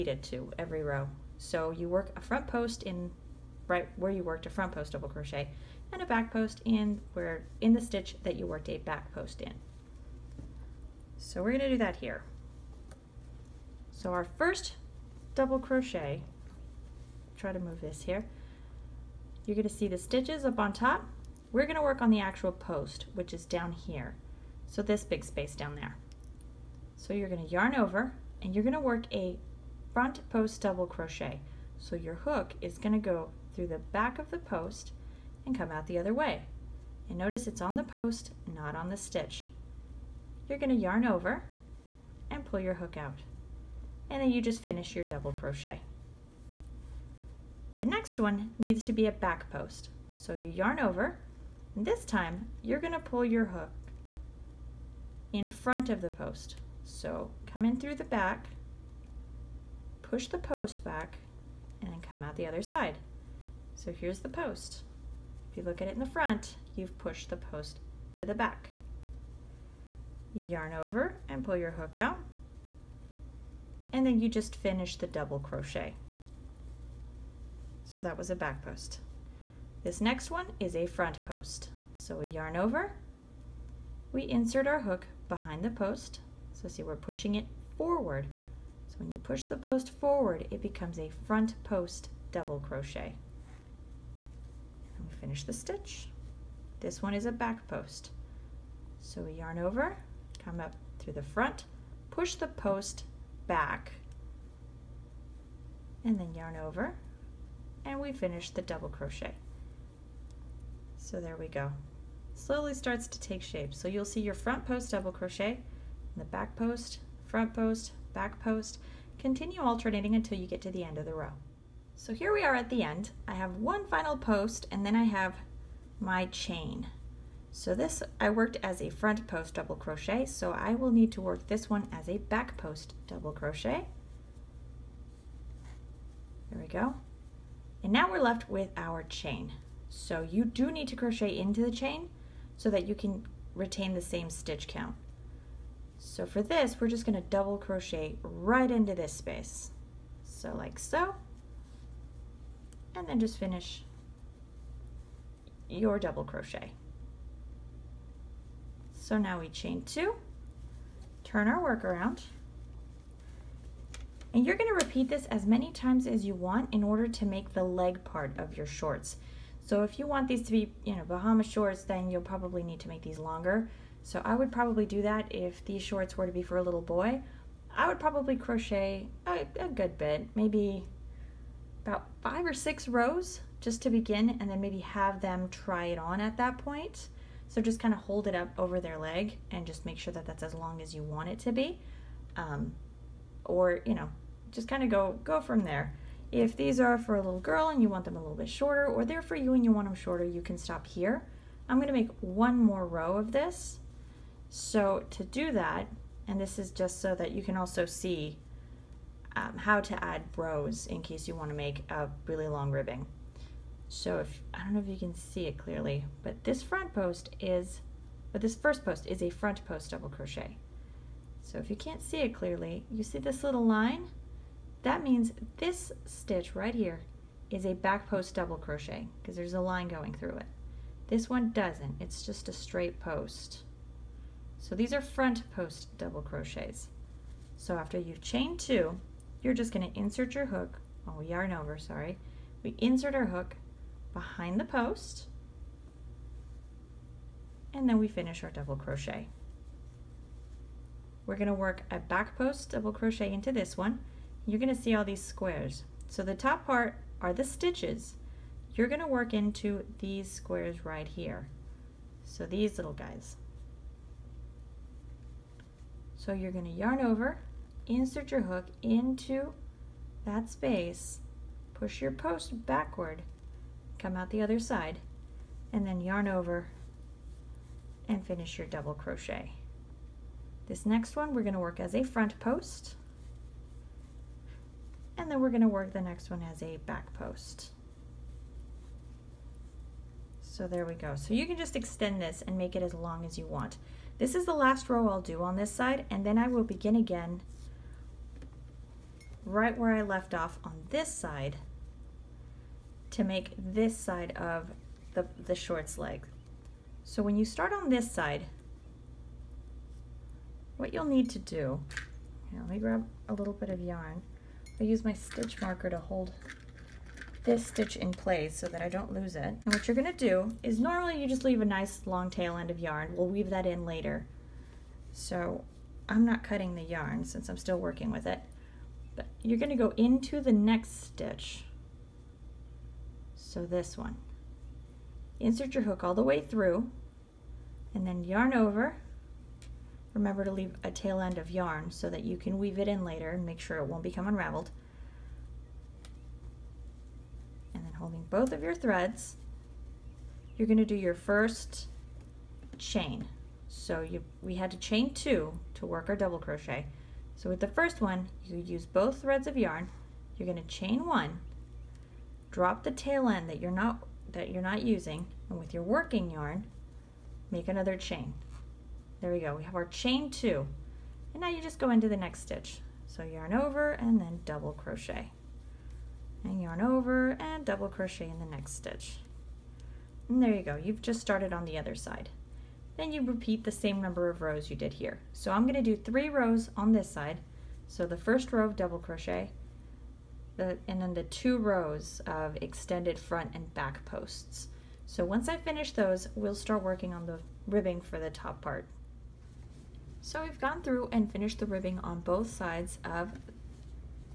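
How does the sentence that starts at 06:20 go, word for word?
You've just started on the other side.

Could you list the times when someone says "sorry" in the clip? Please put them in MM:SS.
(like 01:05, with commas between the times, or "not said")
04:01.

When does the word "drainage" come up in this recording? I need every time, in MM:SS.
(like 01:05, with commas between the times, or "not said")
not said.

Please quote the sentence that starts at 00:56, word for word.
So come in through the back, push the post back, and then come out the other side.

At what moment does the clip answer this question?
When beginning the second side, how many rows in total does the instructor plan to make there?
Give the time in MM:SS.
06:25.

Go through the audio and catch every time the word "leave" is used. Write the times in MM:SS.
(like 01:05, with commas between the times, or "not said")
05:21, 05:40.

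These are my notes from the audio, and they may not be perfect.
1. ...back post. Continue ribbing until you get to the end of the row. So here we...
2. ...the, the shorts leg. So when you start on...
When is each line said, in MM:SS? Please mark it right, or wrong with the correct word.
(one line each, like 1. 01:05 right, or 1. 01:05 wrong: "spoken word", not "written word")
1. 01:58 wrong: "alternating", not "ribbing"
2. 05:05 right.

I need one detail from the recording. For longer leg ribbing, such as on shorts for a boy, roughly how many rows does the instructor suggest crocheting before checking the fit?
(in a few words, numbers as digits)
5 or 6.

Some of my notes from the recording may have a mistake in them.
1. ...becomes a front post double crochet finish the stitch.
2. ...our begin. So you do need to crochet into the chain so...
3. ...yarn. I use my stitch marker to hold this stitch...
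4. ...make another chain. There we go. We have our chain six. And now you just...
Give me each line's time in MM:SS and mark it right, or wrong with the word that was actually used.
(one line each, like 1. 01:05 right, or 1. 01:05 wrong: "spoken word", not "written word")
1. 01:30 right
2. 02:18 wrong: "chain", not "begin"
3. 05:13 right
4. 06:07 wrong: "two", not "six".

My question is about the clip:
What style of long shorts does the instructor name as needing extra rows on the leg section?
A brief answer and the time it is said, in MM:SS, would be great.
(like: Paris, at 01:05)
Bahama shorts, at 02:51.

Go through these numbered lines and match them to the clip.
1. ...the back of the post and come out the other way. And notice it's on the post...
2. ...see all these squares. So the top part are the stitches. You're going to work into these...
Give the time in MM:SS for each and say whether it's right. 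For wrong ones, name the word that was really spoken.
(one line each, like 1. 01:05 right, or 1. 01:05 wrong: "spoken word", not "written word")
1. 00:33 right
2. 04:14 right.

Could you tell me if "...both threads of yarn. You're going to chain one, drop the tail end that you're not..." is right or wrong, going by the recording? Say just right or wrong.
right.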